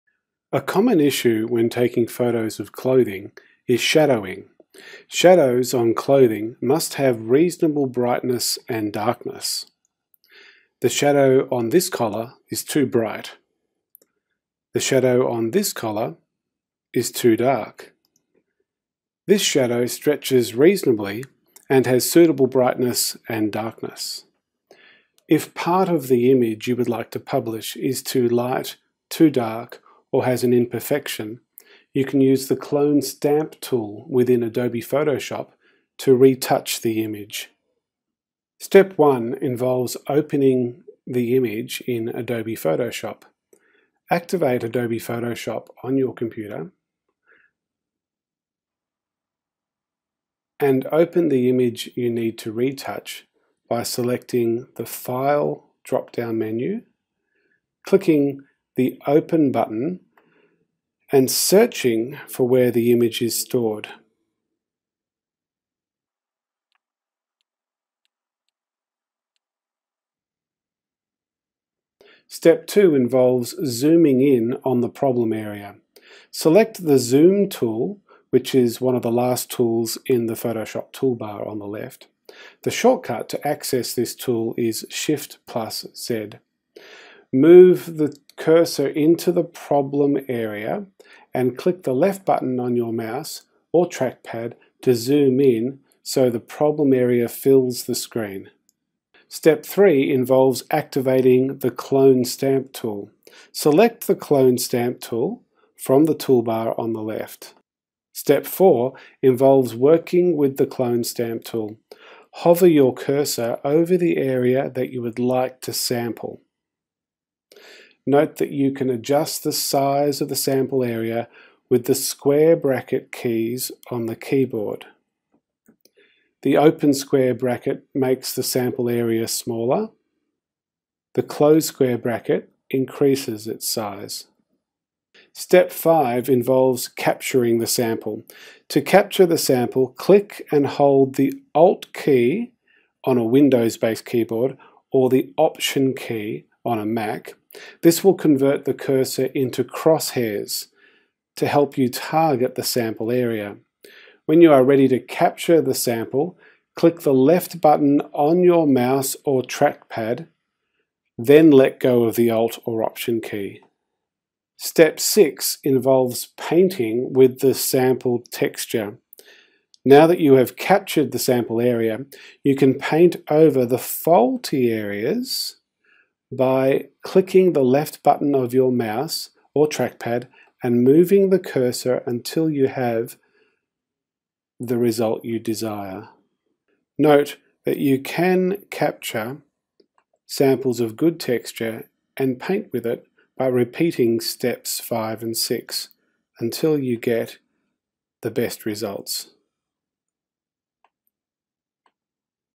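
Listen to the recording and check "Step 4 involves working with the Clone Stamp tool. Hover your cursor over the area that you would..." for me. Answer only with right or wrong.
right.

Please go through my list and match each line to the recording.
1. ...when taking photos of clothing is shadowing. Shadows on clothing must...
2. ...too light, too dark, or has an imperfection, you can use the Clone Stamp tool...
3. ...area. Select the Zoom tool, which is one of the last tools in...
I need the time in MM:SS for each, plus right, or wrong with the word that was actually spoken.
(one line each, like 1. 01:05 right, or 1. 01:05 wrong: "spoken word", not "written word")
1. 00:01 right
2. 00:28 right
3. 01:15 right.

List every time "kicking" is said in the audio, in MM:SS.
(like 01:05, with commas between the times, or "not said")
not said.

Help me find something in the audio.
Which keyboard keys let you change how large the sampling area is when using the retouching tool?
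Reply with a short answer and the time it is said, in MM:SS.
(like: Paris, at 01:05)
square bracket keys, at 02:01.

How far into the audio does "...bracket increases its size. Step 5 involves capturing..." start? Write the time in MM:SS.
02:11.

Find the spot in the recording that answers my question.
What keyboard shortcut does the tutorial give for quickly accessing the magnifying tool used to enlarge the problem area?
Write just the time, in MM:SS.
01:24.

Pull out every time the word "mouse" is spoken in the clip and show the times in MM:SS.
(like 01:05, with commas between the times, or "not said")
01:32, 02:38, 02:58.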